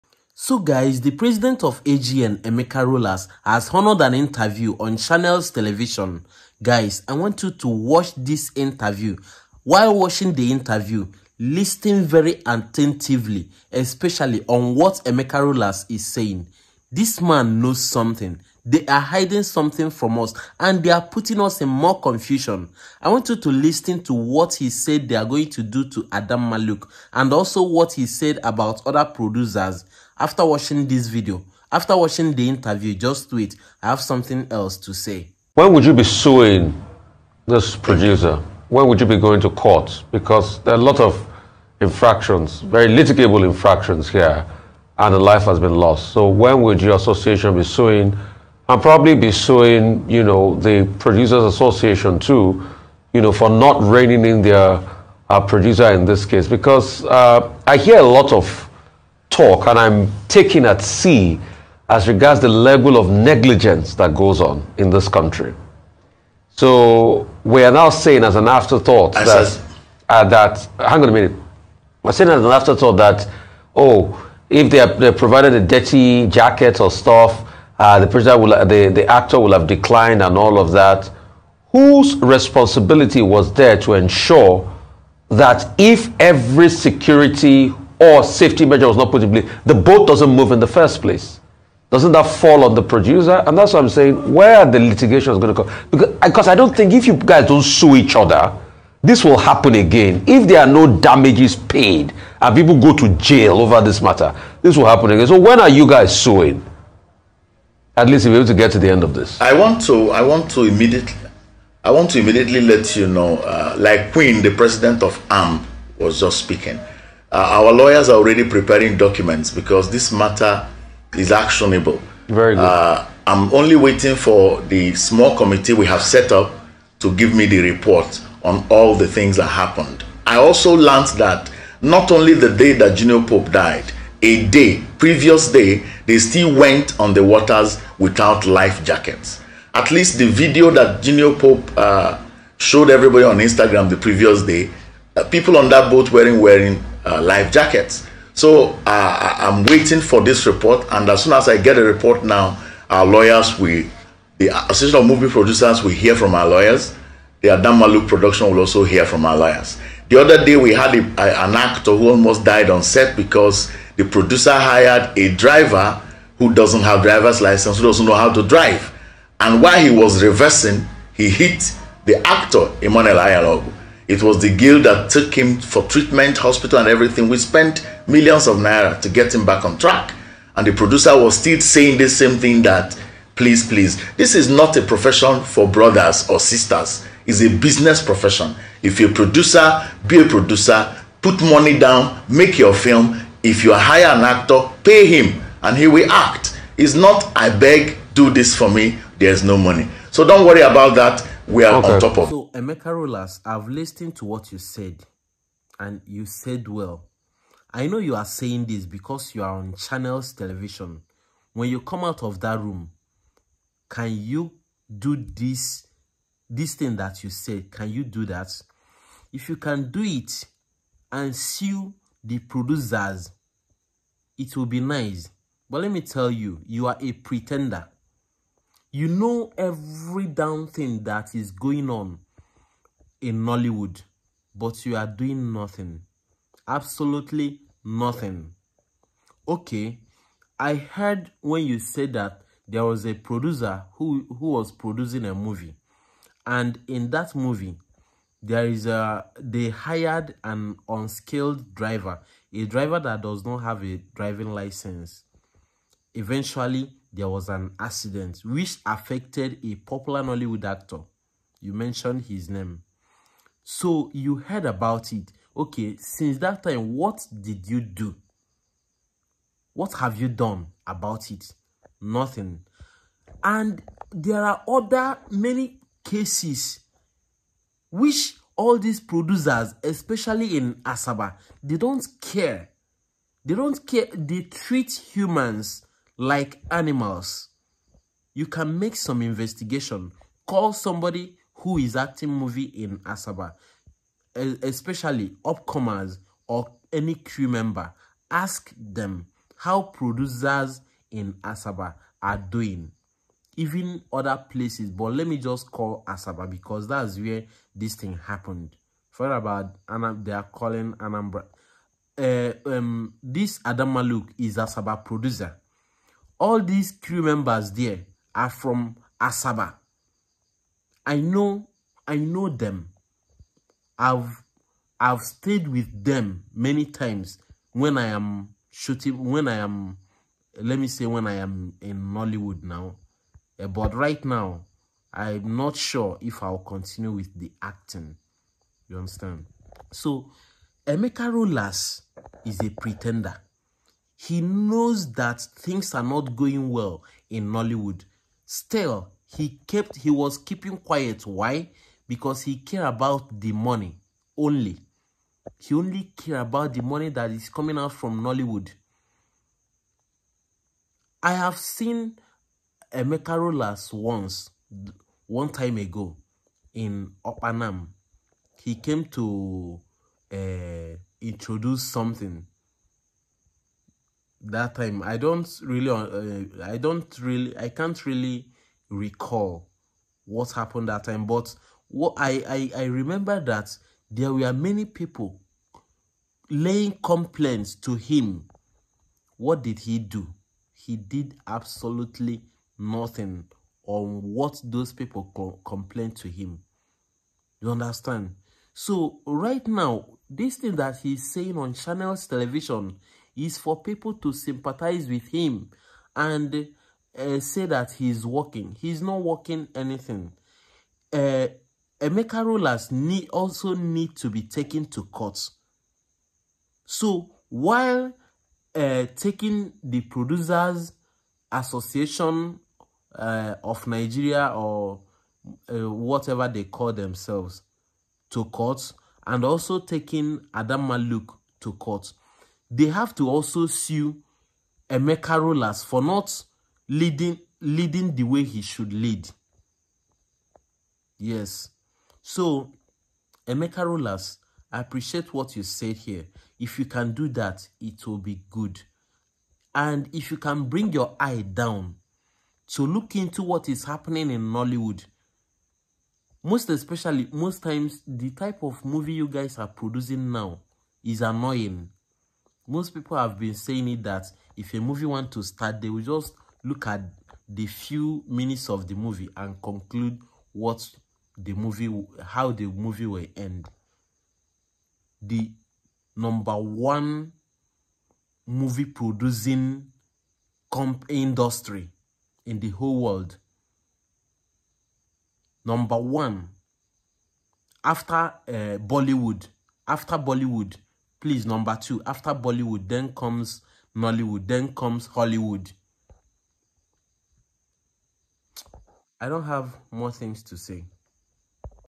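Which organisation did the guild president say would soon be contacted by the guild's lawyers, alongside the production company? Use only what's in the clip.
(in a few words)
Association of Movie Producers.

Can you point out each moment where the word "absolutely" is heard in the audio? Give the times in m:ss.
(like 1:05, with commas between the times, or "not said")
3:56, 6:31.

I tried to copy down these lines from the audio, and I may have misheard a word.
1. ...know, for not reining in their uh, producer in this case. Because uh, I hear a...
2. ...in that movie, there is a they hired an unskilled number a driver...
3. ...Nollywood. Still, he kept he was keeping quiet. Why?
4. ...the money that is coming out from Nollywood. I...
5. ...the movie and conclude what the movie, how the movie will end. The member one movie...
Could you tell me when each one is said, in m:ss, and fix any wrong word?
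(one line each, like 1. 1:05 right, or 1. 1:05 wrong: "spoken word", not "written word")
1. 0:53 right
2. 4:06 wrong: "driver", not "number"
3. 5:47 right
4. 5:56 right
5. 7:48 wrong: "number", not "member".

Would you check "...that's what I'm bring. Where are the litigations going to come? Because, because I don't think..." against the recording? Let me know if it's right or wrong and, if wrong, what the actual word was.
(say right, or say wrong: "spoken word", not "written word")
wrong: "saying", not "bring".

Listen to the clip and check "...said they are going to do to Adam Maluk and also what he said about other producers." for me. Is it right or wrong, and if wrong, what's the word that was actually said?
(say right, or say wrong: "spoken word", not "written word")
right.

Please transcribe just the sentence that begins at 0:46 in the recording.
So when would your association be suing?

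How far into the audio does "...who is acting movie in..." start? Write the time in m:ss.
4:51.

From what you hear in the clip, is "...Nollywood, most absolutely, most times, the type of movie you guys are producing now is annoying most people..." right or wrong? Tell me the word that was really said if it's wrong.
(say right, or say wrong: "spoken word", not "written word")
wrong: "especially", not "absolutely".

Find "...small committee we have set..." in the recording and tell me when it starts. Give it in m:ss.
2:04.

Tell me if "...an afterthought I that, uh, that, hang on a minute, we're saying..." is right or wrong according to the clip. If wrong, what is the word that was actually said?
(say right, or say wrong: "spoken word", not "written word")
right.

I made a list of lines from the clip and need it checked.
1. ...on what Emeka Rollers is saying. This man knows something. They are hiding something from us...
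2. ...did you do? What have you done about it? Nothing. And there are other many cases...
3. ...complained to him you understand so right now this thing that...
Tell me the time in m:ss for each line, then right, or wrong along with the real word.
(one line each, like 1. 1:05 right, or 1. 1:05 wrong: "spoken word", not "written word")
1. 0:14 right
2. 4:27 right
3. 6:35 right.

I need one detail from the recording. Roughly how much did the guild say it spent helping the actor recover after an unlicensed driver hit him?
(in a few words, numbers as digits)
Millions of naira.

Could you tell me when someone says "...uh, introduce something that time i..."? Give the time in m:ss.
6:10.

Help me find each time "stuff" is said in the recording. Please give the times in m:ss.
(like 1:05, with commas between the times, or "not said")
1:16.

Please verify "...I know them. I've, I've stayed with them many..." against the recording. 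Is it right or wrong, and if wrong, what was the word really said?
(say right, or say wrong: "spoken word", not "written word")
right.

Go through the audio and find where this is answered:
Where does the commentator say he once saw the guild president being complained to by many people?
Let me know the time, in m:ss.
6:07.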